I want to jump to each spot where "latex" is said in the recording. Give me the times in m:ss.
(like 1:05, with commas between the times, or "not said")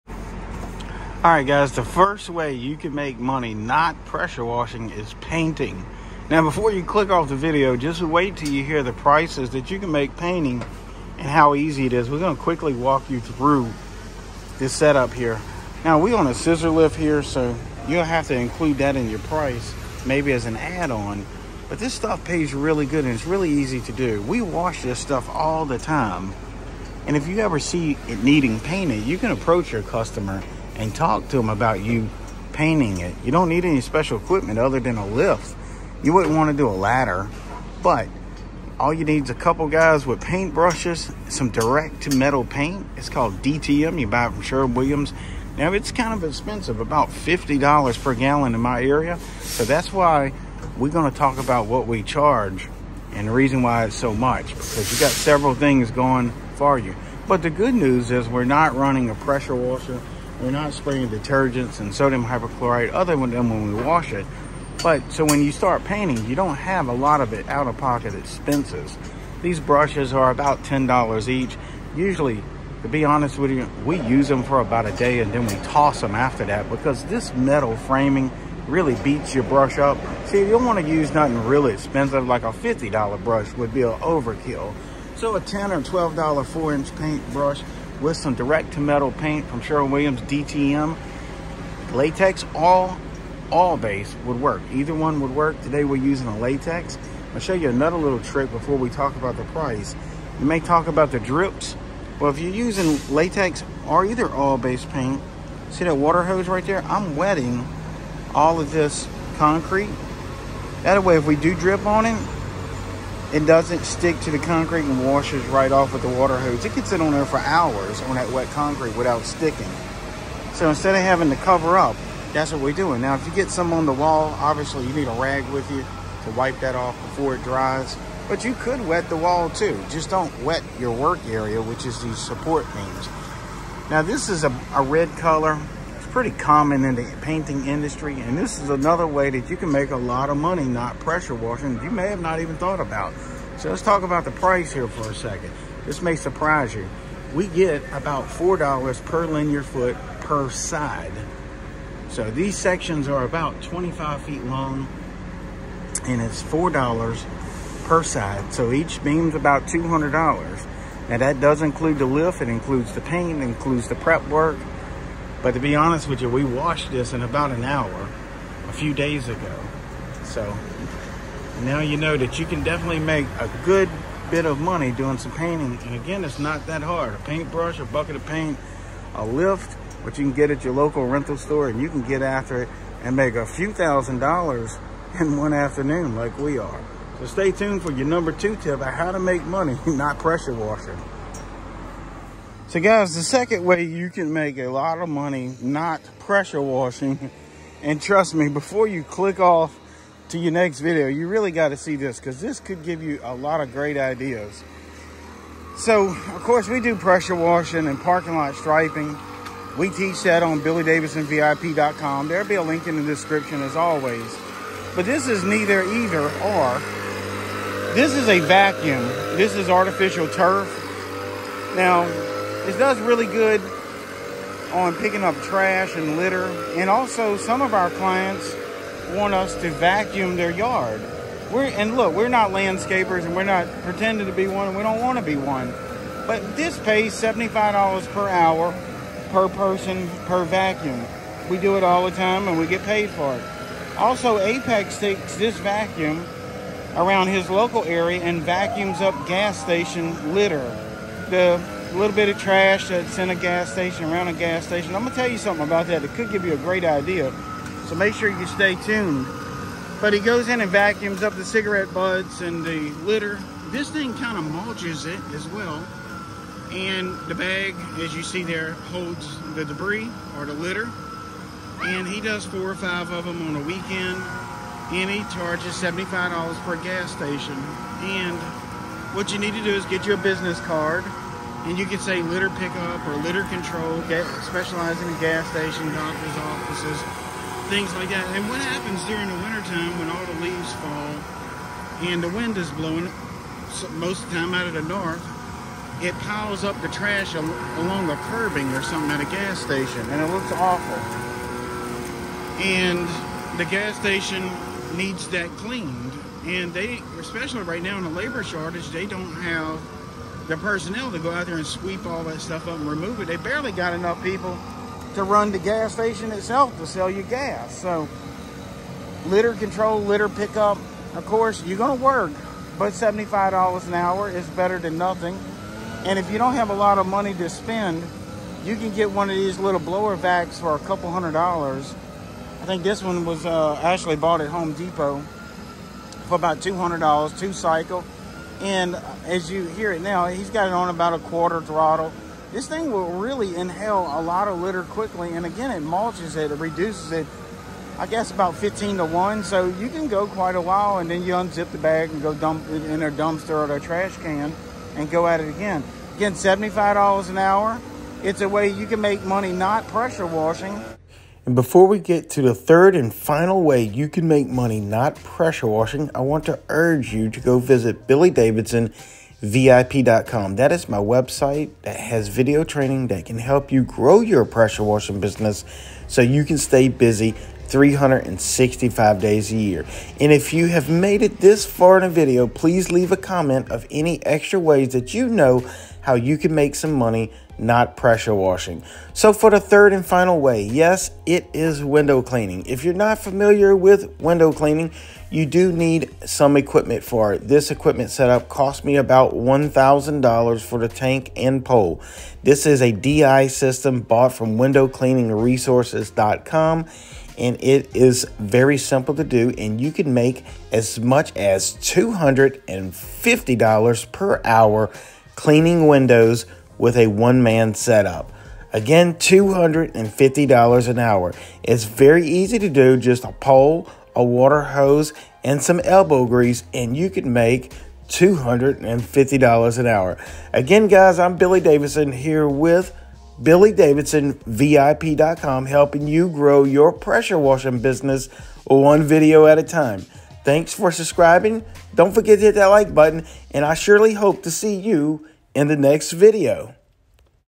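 1:31, 1:36, 1:43.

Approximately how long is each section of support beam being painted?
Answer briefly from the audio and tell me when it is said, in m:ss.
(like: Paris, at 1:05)
25 feet, at 2:33.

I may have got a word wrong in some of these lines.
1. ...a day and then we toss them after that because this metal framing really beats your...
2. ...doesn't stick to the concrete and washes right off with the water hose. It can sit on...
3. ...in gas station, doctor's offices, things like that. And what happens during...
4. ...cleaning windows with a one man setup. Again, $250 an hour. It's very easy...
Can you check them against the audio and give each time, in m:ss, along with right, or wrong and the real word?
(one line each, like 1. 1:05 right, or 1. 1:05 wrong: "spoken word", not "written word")
1. 1:14 right
2. 1:53 right
3. 4:45 right
4. 6:55 right.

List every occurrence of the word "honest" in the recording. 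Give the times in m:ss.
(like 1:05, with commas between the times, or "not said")
1:13, 2:45.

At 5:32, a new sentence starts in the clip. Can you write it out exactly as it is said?
I think this one was uh, actually bought at Home Depot for about $200, two cycle.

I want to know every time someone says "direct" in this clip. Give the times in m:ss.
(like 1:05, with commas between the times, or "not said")
0:41, 1:28.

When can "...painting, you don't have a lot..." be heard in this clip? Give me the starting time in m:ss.
1:05.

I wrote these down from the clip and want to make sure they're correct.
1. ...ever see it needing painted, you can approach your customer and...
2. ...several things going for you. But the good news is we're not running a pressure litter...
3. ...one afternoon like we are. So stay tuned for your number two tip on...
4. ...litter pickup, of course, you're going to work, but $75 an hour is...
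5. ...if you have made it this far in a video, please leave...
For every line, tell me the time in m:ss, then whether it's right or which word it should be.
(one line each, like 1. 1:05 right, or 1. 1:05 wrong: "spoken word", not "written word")
1. 0:27 right
2. 0:55 wrong: "washer", not "litter"
3. 3:05 right
4. 5:20 right
5. 6:20 right.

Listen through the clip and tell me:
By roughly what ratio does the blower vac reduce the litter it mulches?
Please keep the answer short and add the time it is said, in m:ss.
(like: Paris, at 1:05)
15 to 1, at 5:48.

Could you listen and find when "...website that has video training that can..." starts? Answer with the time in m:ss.
6:10.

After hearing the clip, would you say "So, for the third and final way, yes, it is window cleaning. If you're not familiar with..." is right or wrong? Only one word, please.
right.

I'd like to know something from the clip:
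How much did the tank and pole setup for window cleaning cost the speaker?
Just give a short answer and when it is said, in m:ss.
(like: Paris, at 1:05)
$1,000, at 6:39.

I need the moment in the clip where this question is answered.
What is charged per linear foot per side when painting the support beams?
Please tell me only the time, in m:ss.
2:28.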